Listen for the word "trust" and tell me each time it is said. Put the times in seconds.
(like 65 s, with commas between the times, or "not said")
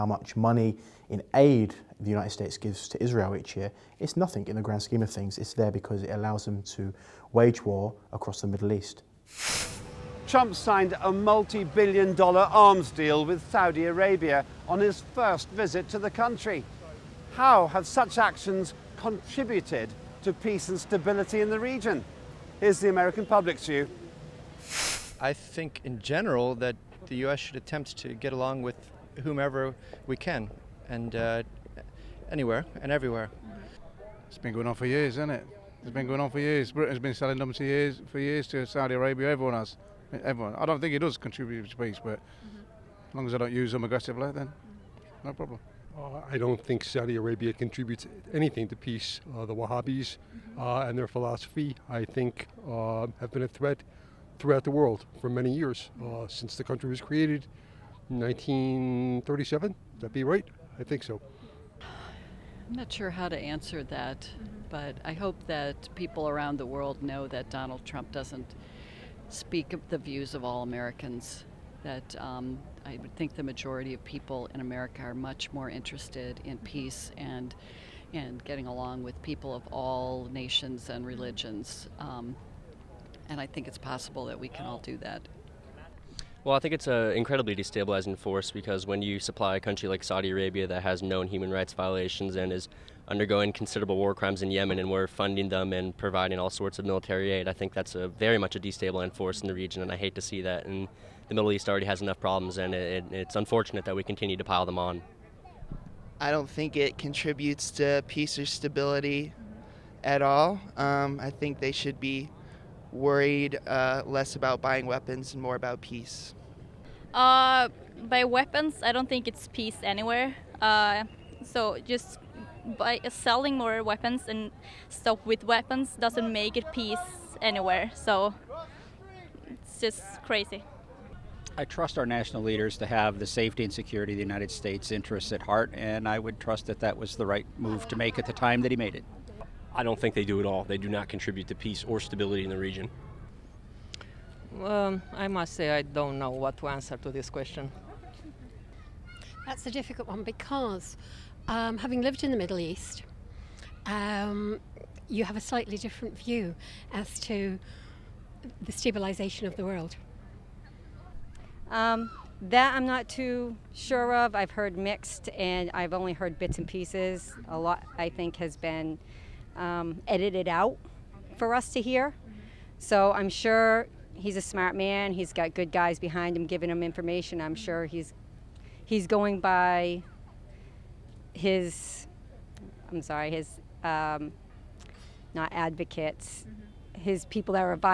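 131 s, 136 s.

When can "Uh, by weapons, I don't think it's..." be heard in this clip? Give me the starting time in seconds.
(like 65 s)
117 s.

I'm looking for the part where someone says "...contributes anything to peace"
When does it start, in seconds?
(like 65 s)
47 s.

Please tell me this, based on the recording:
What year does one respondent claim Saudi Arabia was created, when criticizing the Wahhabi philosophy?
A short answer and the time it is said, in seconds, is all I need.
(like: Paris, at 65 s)
1937, at 58 s.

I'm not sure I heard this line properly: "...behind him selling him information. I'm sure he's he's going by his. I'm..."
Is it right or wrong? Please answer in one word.
wrong.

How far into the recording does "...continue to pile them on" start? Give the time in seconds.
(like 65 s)
104 s.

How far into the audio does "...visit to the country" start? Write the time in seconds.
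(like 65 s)
15 s.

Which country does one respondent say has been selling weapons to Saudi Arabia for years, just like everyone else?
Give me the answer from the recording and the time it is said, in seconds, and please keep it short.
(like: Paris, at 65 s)
Britain, at 36 s.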